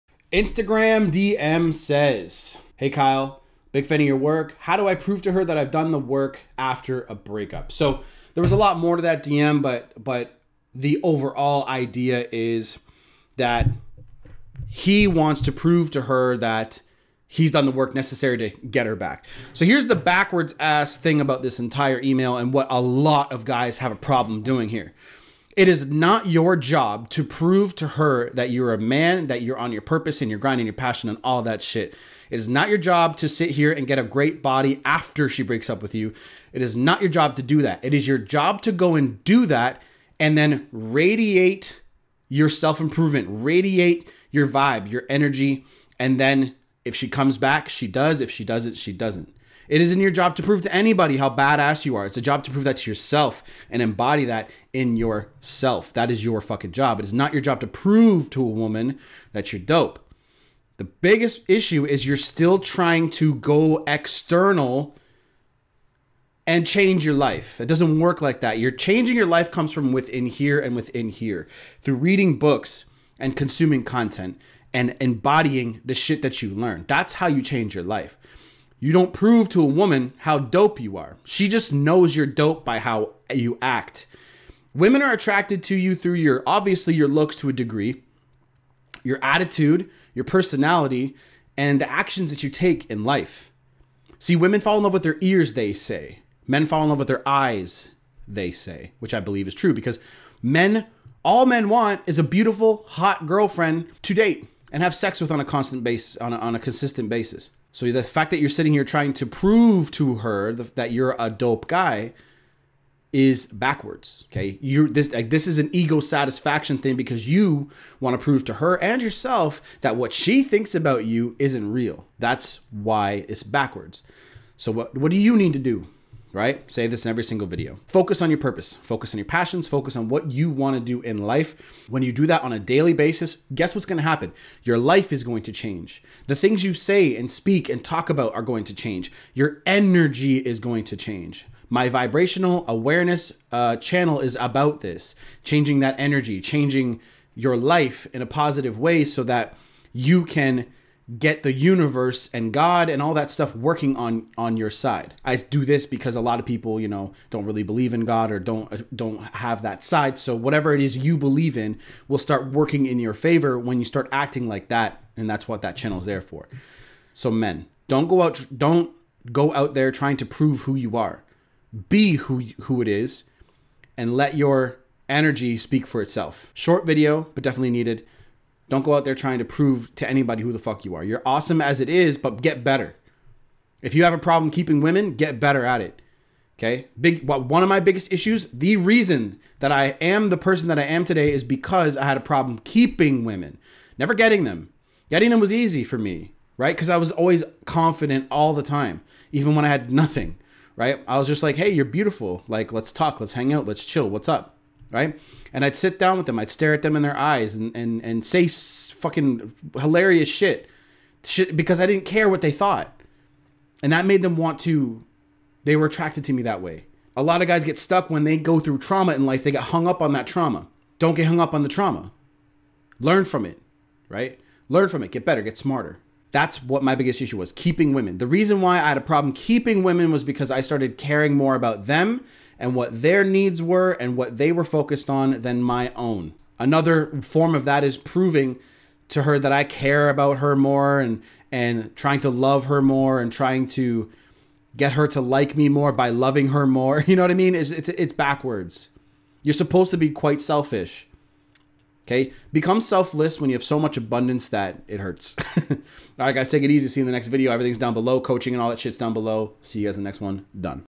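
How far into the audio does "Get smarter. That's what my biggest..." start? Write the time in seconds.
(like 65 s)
225 s.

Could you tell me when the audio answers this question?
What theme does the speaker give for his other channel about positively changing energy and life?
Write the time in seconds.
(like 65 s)
141 s.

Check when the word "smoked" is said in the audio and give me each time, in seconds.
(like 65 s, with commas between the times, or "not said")
not said.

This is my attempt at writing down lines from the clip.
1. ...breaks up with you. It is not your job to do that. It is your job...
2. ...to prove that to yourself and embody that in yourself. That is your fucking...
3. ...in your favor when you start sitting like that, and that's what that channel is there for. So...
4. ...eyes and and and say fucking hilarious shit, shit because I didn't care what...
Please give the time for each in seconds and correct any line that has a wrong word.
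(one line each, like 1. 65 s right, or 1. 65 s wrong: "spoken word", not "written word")
1. 35 s right
2. 52 s right
3. 162 s wrong: "acting", not "sitting"
4. 207 s right.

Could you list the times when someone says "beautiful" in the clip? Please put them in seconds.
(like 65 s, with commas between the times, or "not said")
102 s, 201 s.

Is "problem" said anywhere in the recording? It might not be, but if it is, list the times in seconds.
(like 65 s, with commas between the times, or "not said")
23 s, 184 s, 192 s, 229 s.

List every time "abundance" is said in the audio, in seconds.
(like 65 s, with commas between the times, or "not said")
253 s.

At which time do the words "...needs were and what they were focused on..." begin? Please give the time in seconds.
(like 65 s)
233 s.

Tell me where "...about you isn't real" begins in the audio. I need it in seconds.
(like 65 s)
120 s.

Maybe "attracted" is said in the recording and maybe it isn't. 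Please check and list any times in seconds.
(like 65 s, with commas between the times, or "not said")
85 s, 215 s.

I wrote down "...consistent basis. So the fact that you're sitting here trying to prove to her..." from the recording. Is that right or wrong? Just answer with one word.
right.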